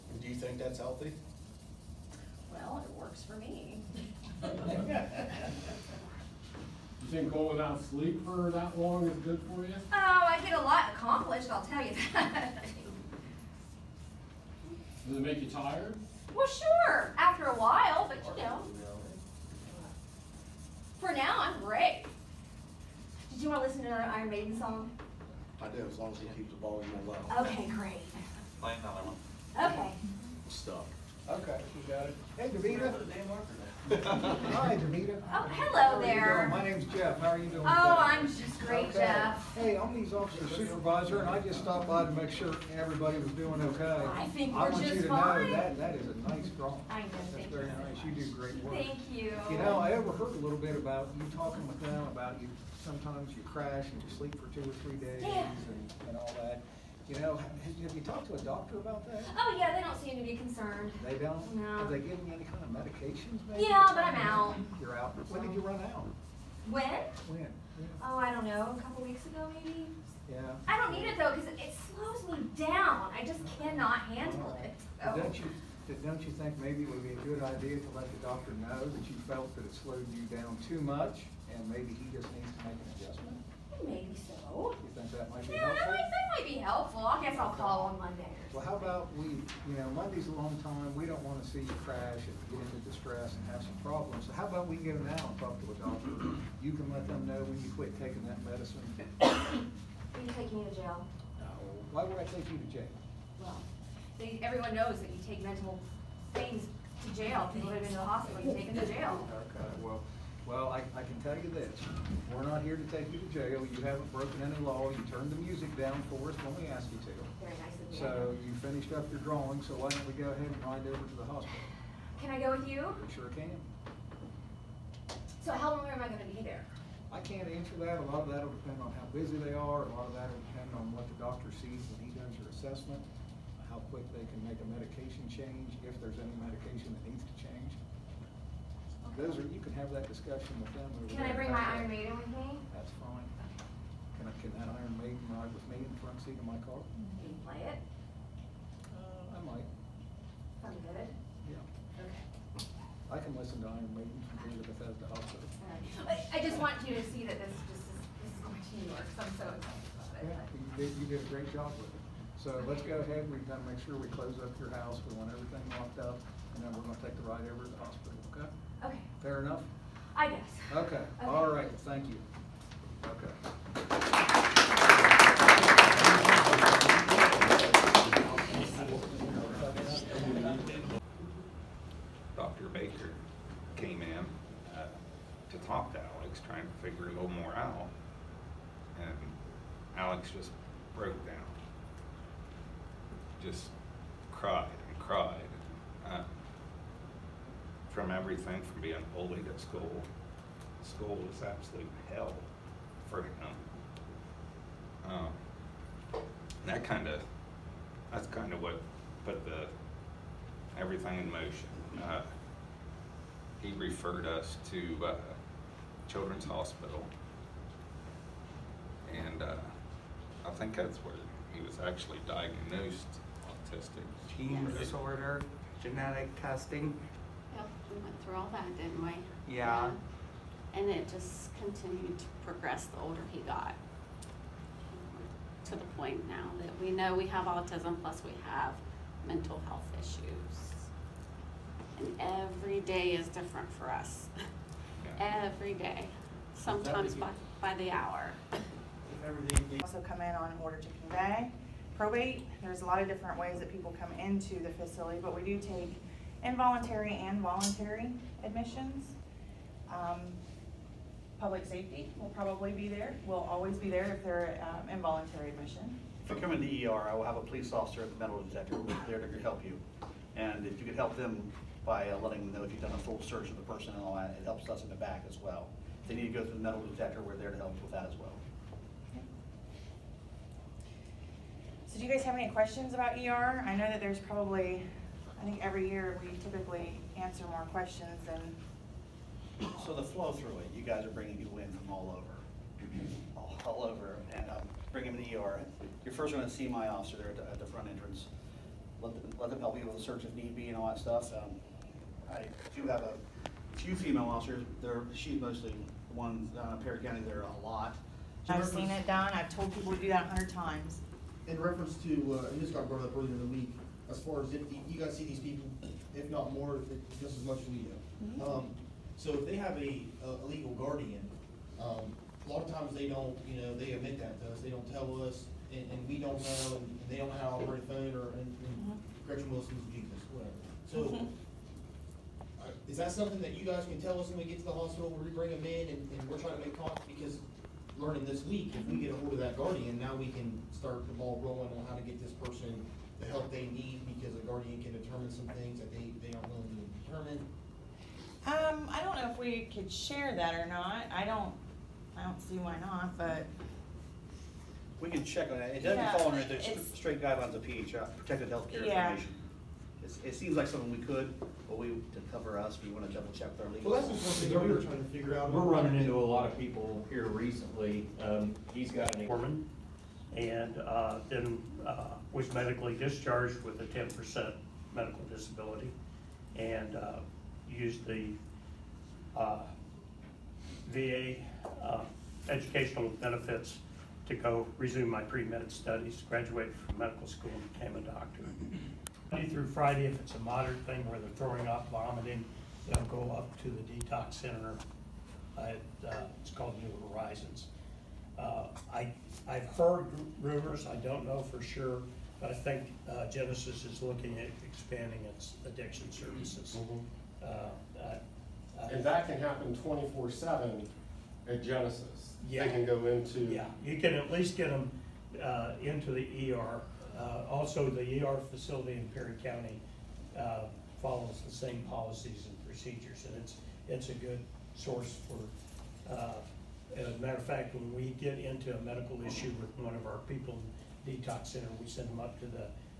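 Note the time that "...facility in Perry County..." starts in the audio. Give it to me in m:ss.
6:58.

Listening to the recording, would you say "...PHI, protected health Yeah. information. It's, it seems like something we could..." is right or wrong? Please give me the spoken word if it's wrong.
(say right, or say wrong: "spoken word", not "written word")
right.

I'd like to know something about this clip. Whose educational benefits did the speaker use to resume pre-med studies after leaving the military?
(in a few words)
VA.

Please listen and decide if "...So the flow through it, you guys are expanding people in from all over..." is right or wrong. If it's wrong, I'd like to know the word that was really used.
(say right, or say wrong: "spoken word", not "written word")
wrong: "bringing", not "expanding".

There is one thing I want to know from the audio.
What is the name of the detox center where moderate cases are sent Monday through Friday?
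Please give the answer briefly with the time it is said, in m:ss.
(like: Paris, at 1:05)
New Horizons, at 6:36.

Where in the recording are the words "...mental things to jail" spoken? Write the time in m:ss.
1:45.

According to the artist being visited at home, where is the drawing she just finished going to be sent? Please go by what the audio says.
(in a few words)
New York.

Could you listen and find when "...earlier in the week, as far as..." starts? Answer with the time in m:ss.
5:13.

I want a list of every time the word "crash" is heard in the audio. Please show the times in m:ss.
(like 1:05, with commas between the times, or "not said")
0:53, 1:31.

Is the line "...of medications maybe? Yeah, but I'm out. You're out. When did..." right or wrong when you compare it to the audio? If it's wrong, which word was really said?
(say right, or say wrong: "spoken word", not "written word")
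right.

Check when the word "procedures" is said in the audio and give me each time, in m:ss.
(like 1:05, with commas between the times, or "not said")
7:02.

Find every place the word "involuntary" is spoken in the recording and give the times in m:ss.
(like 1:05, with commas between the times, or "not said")
4:16, 4:24.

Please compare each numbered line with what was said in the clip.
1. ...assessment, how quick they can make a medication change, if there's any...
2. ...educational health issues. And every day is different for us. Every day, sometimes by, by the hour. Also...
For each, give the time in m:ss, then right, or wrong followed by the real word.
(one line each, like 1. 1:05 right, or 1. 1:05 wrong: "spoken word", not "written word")
1. 2:12 right
2. 3:59 wrong: "mental", not "educational".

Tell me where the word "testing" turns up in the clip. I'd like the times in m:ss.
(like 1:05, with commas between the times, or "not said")
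3:46.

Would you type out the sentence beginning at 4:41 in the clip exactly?
So do you guys have any questions about ER?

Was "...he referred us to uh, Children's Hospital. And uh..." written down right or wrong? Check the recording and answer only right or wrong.
right.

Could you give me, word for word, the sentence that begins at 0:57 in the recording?
You know, have, have you talked to a doctor about that?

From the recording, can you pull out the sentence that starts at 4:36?
If they need to go through the metal detector, we're there to help with that as well.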